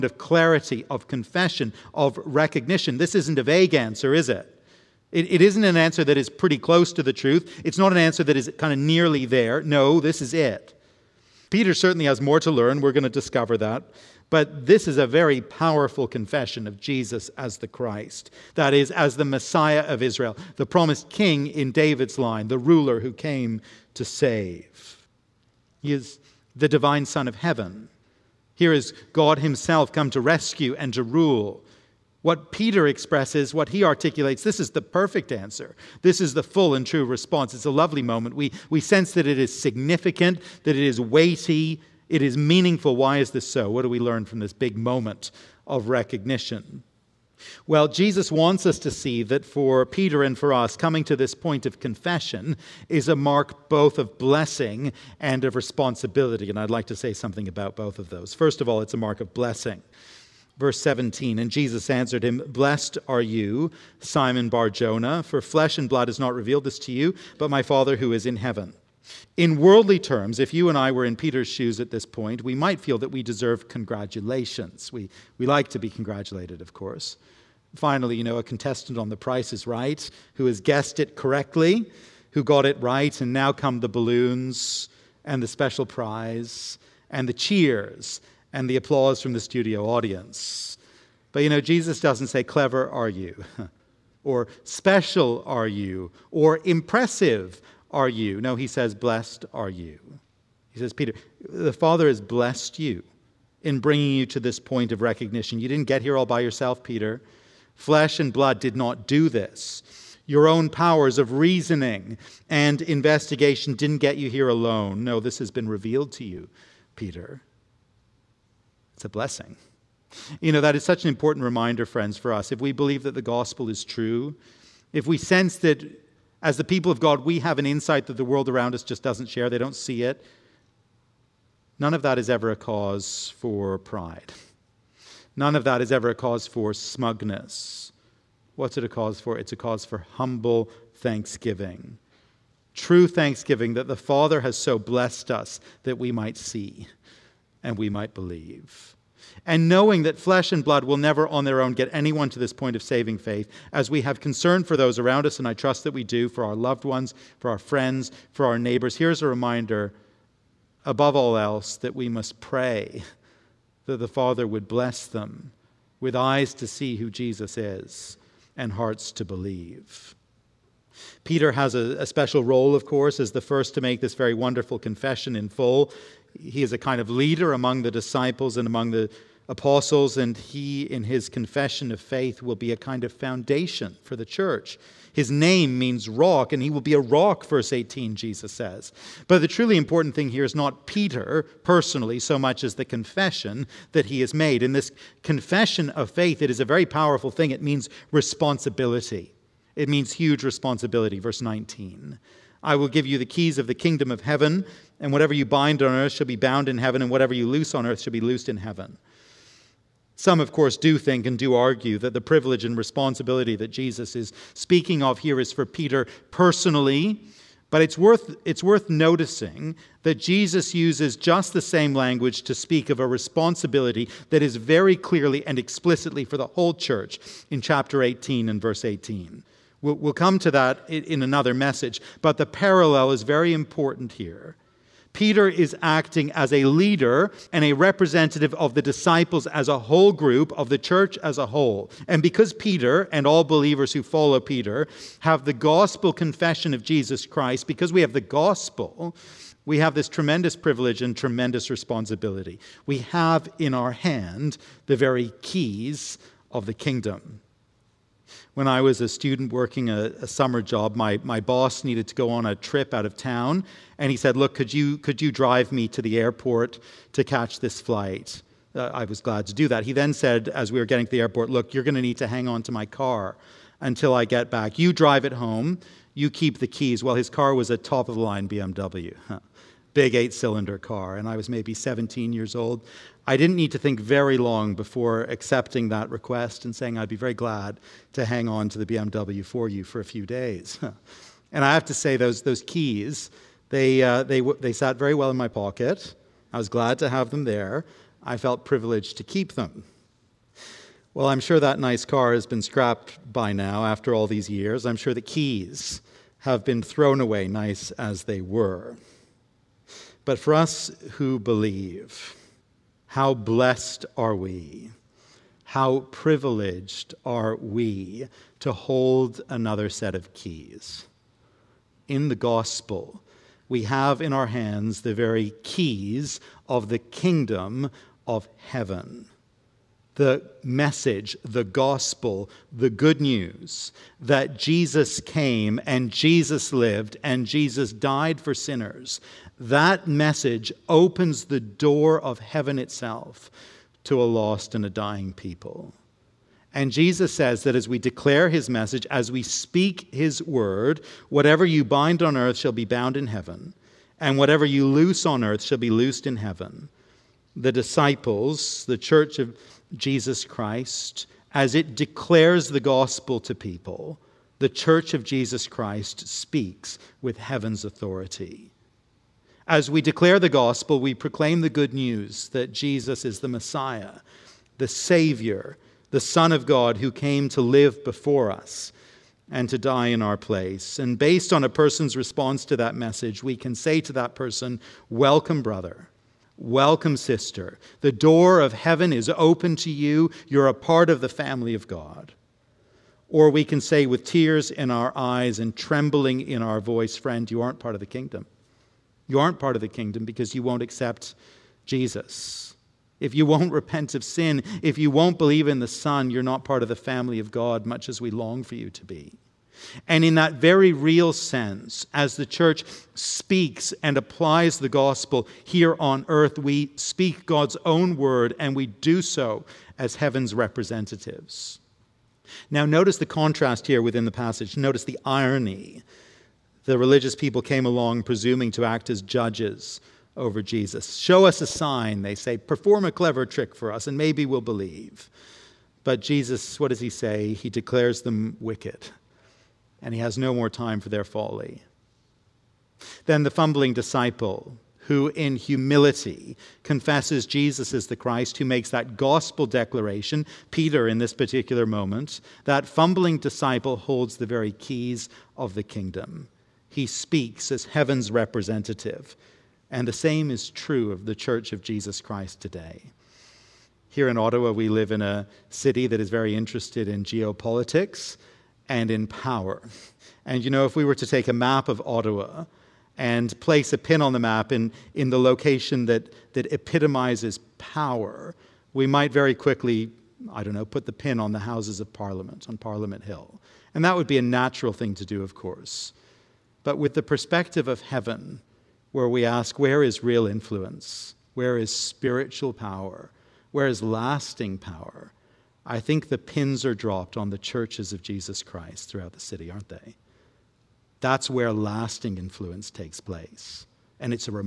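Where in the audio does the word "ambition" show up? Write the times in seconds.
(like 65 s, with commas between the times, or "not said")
not said.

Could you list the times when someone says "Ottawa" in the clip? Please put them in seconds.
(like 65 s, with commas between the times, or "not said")
464 s, 472 s.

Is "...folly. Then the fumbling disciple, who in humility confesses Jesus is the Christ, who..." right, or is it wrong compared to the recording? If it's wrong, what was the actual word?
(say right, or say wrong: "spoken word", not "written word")
right.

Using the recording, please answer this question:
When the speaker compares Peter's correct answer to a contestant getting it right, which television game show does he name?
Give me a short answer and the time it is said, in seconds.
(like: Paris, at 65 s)
The Price is Right, at 79 s.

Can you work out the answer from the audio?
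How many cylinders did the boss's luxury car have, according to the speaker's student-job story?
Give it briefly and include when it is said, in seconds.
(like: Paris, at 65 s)
8, at 280 s.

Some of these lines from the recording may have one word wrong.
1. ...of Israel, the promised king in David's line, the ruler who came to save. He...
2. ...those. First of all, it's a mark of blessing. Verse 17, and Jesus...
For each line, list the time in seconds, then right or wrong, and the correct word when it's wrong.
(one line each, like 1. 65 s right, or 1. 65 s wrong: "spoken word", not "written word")
1. 19 s right
2. 58 s right.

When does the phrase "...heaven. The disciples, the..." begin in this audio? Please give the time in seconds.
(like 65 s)
356 s.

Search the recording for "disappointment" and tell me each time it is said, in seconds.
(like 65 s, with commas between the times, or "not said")
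not said.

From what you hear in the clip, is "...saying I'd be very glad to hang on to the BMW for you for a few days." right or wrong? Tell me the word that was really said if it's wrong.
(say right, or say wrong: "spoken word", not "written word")
right.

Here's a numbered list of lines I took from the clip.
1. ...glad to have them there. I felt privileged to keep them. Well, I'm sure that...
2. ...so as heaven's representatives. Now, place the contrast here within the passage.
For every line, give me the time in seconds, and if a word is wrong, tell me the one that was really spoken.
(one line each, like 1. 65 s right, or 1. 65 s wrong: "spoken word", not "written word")
1. 296 s right
2. 419 s wrong: "notice", not "place".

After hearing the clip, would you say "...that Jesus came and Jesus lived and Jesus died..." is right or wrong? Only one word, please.
right.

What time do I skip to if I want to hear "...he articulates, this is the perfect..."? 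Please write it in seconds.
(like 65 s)
33 s.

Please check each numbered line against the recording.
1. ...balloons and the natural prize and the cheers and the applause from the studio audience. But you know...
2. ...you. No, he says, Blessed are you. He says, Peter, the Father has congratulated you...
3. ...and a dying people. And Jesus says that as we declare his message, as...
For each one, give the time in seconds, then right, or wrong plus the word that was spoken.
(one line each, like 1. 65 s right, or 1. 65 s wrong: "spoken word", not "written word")
1. 83 s wrong: "special", not "natural"
2. 98 s wrong: "blessed", not "congratulated"
3. 344 s right.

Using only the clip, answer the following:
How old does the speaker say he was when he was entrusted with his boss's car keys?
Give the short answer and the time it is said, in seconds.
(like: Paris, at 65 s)
17, at 281 s.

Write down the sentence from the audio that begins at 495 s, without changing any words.
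I think the pins are dropped on the churches of Jesus Christ throughout the city, aren't they?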